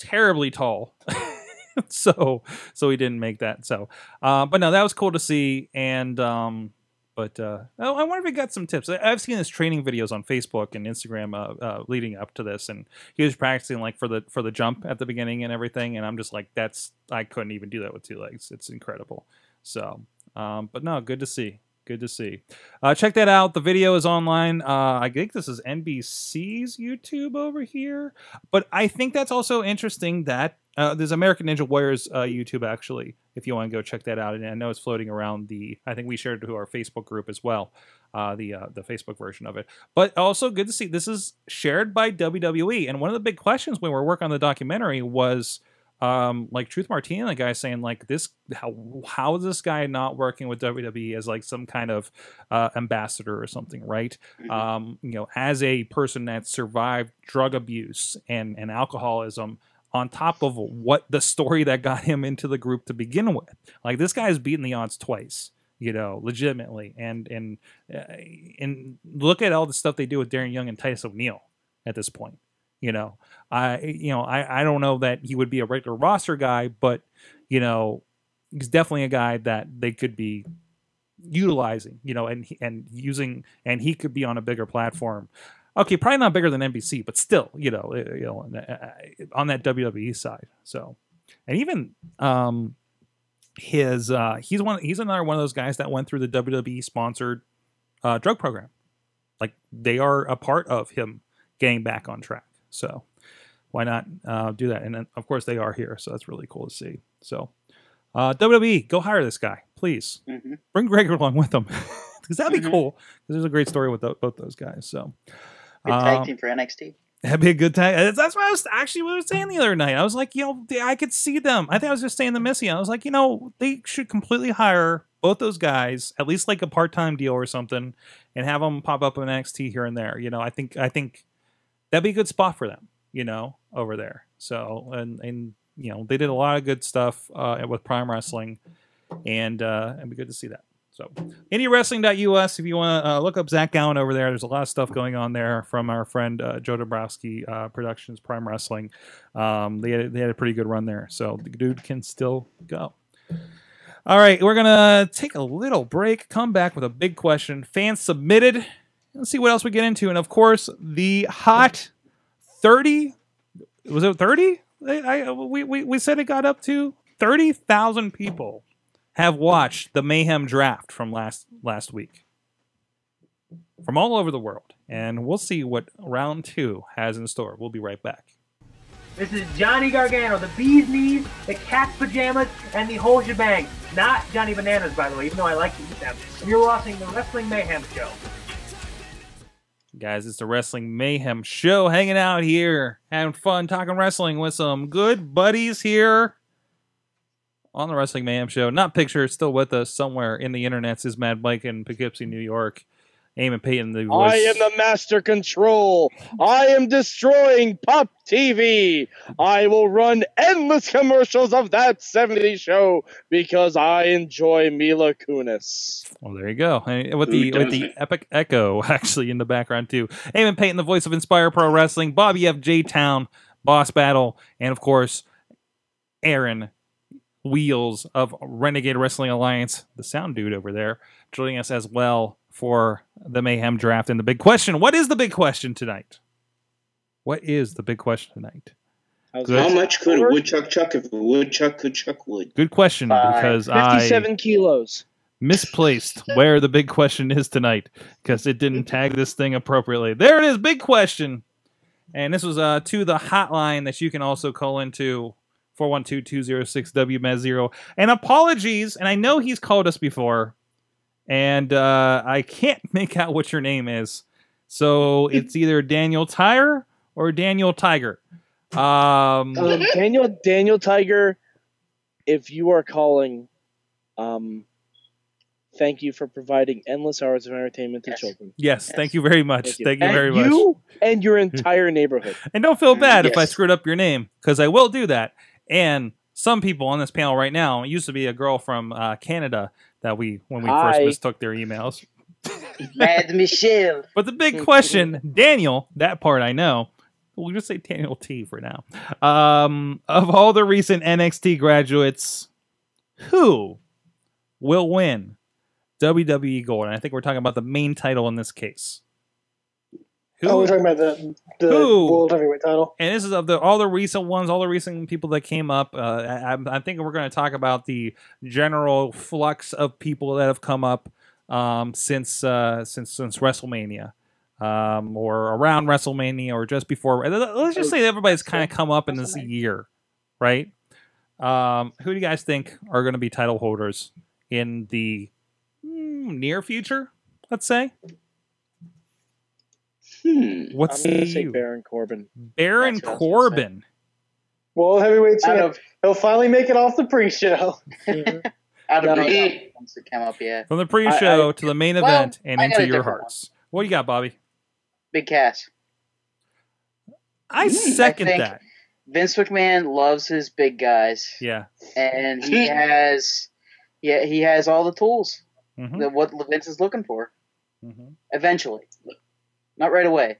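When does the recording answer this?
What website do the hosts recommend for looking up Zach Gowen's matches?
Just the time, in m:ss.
2:21.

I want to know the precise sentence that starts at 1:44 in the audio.
And then, of course, they are here, so that's really cool to see.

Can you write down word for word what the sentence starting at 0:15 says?
And I'm just like, that's I couldn't even do that with two legs.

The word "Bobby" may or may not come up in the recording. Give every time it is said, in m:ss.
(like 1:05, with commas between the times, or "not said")
3:42, 5:54.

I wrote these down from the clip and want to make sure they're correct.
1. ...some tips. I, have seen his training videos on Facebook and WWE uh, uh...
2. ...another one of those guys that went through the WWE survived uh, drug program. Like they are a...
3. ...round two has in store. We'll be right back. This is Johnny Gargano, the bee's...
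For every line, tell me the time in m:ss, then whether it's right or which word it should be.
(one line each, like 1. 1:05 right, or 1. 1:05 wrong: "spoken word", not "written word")
1. 0:08 wrong: "Instagram", not "WWE"
2. 1:34 wrong: "sponsored", not "survived"
3. 2:55 right.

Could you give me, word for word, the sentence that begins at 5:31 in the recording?
Um, who do you guys think are going to be title holders in the mm, near future?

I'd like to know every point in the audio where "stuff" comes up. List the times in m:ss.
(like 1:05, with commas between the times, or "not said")
1:09, 2:16, 2:24.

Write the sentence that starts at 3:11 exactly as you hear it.
Hanging out here, having fun, talking wrestling with some good buddies here on the Wrestling Mayhem Show.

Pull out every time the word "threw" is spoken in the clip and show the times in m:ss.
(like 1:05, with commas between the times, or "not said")
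not said.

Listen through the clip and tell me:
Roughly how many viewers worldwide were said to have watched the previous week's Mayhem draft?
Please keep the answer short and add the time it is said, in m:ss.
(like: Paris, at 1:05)
30,000, at 2:47.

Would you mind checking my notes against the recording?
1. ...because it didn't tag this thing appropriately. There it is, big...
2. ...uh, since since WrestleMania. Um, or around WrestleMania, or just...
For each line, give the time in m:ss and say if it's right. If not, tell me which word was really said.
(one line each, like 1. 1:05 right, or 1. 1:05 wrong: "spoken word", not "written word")
1. 4:08 right
2. 5:22 right.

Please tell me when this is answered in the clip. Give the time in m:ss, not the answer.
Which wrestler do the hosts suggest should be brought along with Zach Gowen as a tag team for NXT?
1:50.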